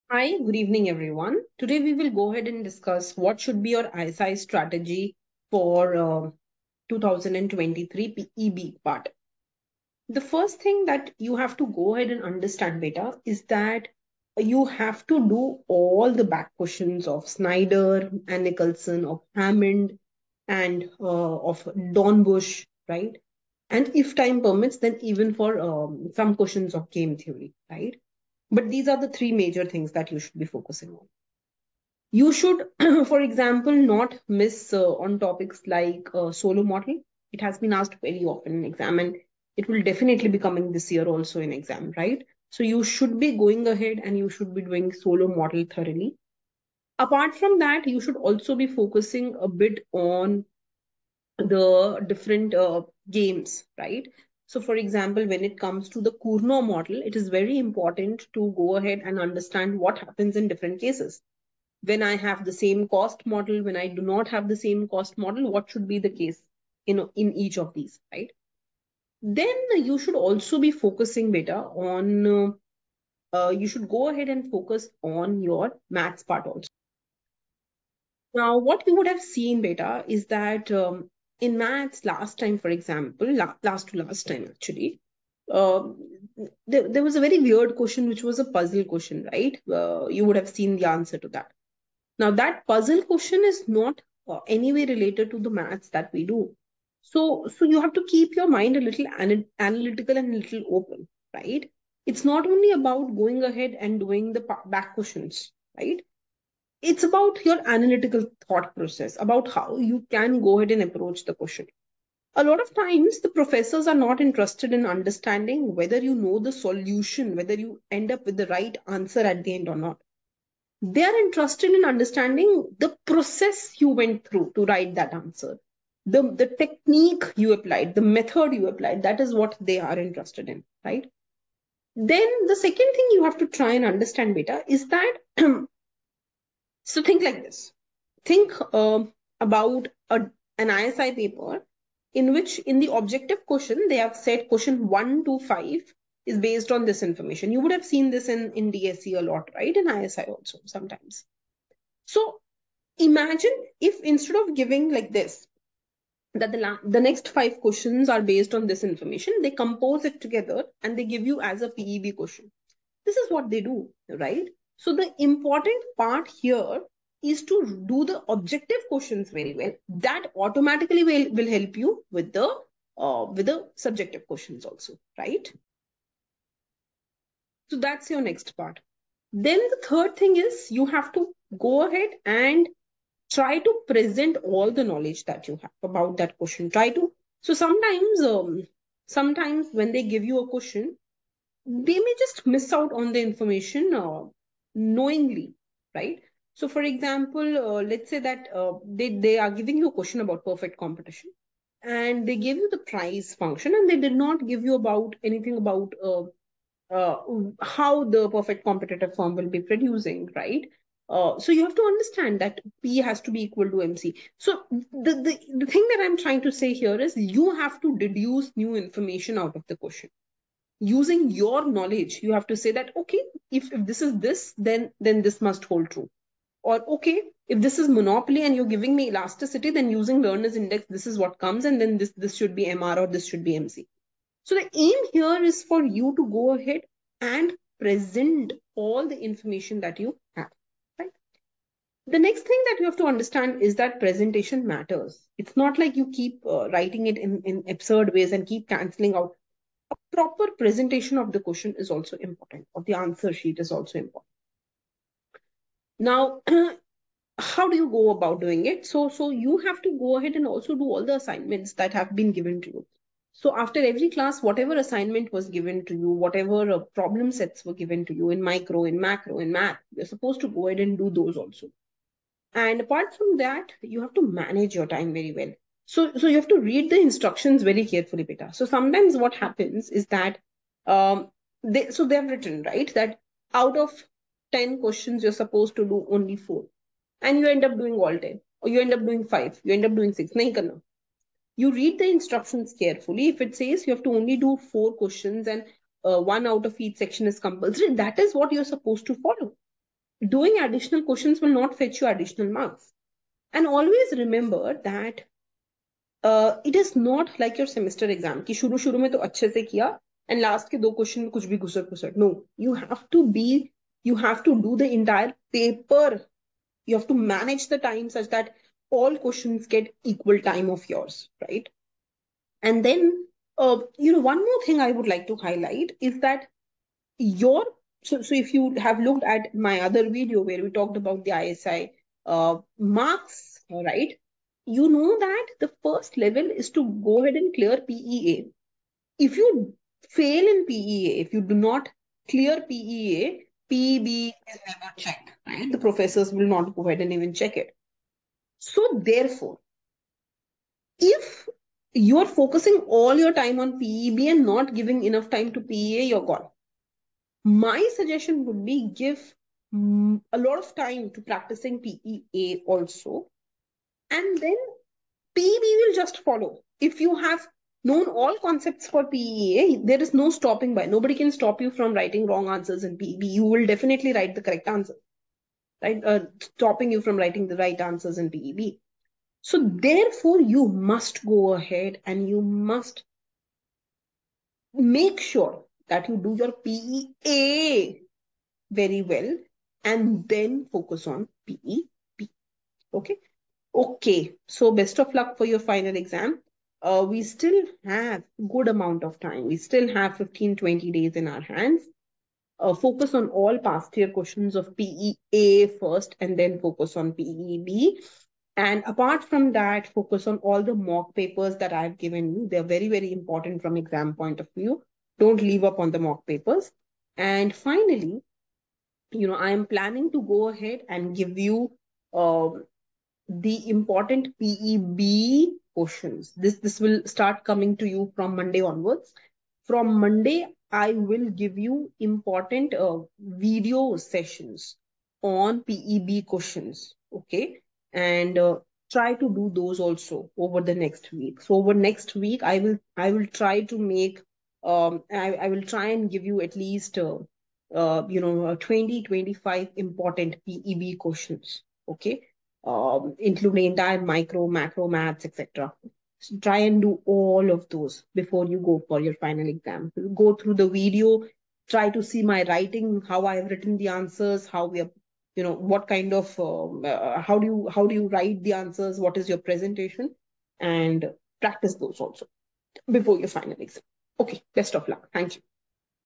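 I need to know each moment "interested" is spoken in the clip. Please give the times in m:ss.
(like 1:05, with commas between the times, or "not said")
1:54, 2:01, 2:09.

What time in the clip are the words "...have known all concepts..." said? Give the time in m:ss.
6:07.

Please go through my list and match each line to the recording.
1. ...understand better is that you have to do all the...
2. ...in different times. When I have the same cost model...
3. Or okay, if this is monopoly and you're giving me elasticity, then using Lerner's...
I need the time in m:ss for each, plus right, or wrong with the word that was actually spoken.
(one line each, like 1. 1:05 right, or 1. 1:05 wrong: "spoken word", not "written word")
1. 0:12 right
2. 1:00 wrong: "cases", not "times"
3. 3:46 right.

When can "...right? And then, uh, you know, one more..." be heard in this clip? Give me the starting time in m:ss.
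5:21.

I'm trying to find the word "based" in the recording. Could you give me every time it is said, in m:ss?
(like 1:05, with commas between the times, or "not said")
2:26, 2:38.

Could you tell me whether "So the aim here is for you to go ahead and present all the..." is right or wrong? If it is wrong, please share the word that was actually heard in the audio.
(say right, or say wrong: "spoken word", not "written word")
right.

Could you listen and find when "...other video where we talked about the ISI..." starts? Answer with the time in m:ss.
5:29.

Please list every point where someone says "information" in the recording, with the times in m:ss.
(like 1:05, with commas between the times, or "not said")
2:27, 2:38, 3:13, 3:38, 3:59.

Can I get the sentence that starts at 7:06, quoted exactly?
This, this will start coming to you from Monday onwards.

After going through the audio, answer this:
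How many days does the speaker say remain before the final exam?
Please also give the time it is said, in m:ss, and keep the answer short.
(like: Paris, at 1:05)
15 to 20 days, at 6:40.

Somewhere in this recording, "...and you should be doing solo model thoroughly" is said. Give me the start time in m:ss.
0:44.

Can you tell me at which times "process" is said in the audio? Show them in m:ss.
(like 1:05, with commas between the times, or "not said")
1:48, 2:03.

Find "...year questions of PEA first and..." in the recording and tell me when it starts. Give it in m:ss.
6:43.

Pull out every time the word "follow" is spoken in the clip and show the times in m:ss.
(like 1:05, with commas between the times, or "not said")
4:59, 6:06.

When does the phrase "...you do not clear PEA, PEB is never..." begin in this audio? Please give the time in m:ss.
5:41.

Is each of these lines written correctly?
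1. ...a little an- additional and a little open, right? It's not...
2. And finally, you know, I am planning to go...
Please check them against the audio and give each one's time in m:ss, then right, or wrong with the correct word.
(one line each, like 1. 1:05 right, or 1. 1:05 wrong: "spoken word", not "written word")
1. 1:38 wrong: "analytical", not "additional"
2. 6:57 right.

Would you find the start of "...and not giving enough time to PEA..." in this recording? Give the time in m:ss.
5:54.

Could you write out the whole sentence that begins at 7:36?
So try and do all of those before you go for your final exam.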